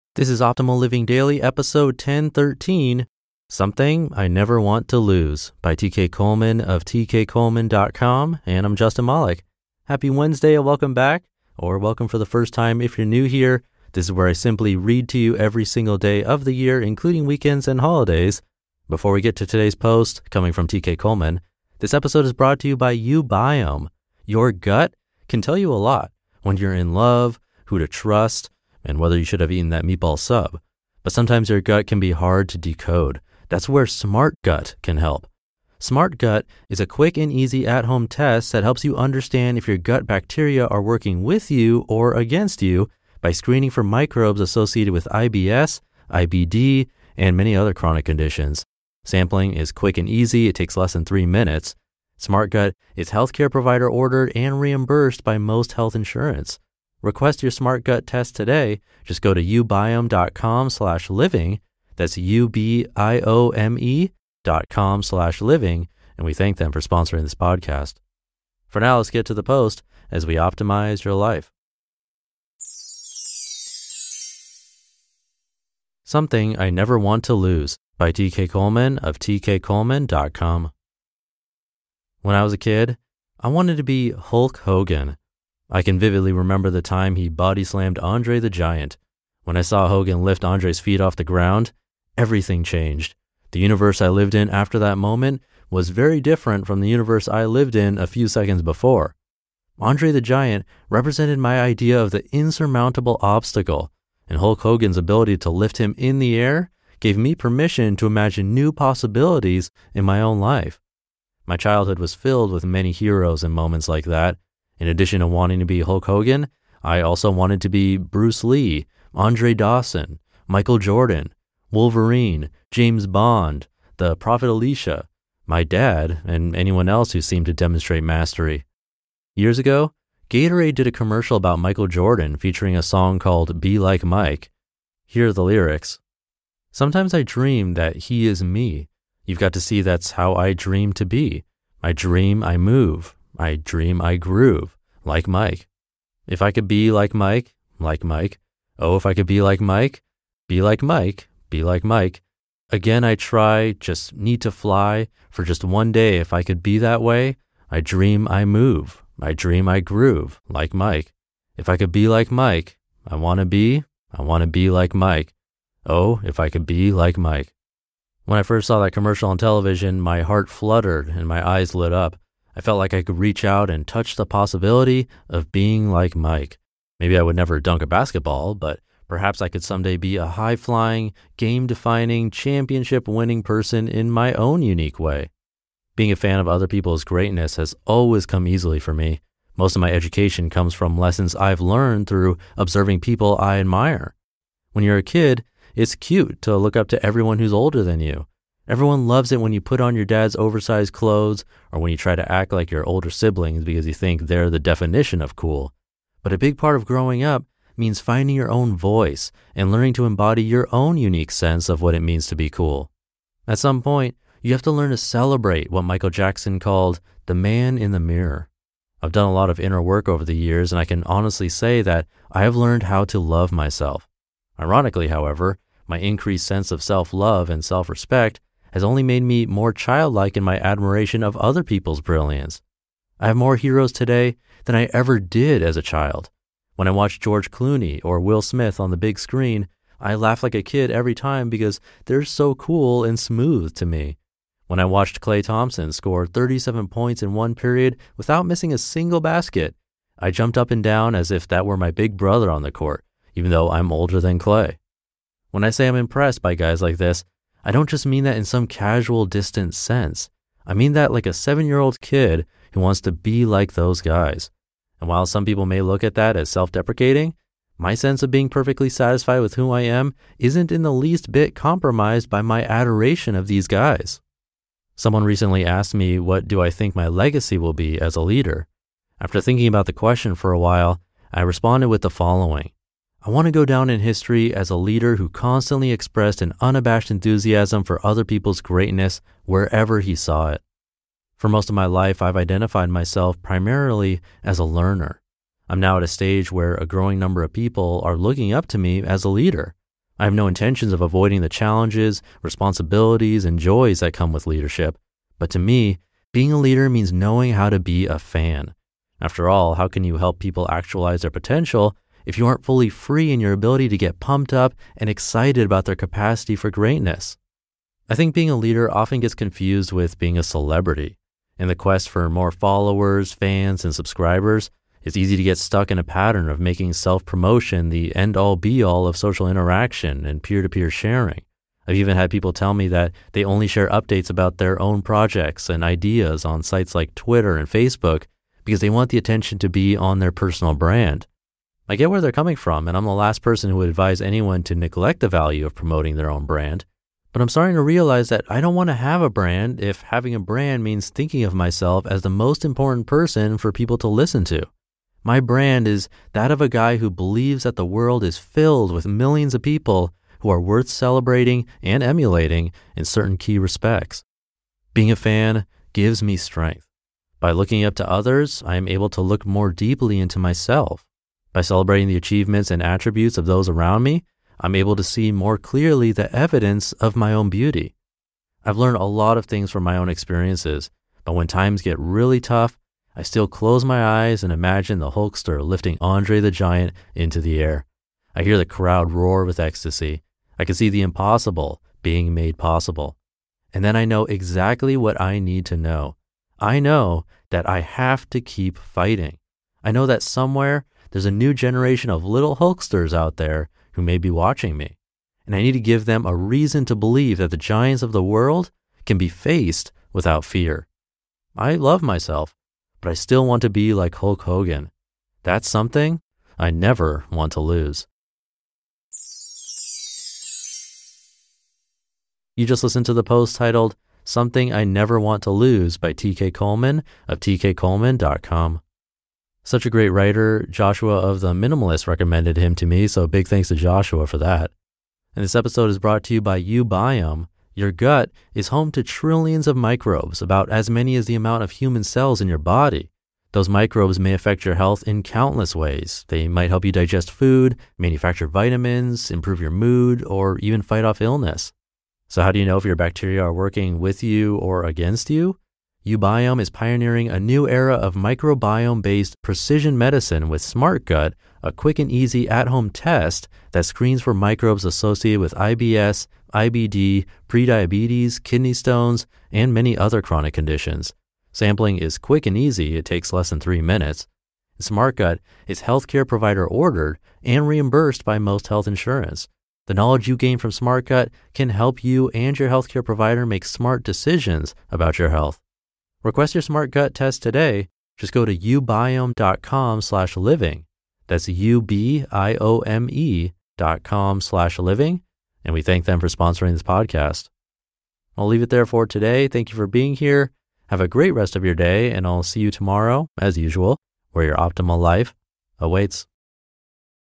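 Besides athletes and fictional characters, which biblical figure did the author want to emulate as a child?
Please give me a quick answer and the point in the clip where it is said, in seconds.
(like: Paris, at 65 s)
the Prophet Elisha, at 123 s.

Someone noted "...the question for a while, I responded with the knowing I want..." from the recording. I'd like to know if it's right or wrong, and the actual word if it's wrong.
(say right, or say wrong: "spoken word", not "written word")
wrong: "following", not "knowing".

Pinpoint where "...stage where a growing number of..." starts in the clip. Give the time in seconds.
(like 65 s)
296 s.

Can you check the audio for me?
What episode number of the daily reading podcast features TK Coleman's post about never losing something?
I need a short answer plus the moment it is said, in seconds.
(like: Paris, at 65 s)
1013, at 1 s.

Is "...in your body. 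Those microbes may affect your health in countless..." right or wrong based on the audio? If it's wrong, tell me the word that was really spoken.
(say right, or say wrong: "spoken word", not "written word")
right.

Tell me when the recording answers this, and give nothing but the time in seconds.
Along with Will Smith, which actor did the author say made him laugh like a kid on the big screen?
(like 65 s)
237 s.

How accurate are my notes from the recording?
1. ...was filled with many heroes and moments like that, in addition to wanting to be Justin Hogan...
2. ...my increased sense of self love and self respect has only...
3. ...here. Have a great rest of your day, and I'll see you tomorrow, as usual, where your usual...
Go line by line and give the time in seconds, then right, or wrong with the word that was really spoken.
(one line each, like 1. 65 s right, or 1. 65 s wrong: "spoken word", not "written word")
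1. 111 s wrong: "Hulk", not "Justin"
2. 225 s right
3. 500 s wrong: "optimal", not "usual".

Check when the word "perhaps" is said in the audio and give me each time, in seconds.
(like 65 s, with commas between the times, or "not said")
179 s.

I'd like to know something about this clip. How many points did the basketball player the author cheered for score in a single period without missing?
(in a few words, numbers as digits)
37.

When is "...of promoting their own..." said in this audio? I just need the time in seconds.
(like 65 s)
345 s.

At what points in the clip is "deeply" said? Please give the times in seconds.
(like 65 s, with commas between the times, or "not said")
369 s.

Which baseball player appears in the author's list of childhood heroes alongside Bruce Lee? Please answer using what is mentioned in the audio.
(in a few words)
Andre Dawson.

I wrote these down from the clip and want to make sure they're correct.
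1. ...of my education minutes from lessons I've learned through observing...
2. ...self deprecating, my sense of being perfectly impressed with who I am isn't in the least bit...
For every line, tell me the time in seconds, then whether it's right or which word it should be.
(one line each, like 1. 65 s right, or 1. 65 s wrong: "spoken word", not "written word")
1. 189 s wrong: "comes", not "minutes"
2. 266 s wrong: "satisfied", not "impressed".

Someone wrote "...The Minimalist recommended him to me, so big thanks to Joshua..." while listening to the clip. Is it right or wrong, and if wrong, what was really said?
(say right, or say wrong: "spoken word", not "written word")
right.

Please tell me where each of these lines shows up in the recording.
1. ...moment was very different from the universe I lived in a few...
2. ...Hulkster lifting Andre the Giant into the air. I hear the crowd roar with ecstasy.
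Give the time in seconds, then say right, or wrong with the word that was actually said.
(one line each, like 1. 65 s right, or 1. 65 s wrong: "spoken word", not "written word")
1. 94 s right
2. 385 s right.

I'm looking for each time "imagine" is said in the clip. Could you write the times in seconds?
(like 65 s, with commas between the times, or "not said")
108 s, 384 s.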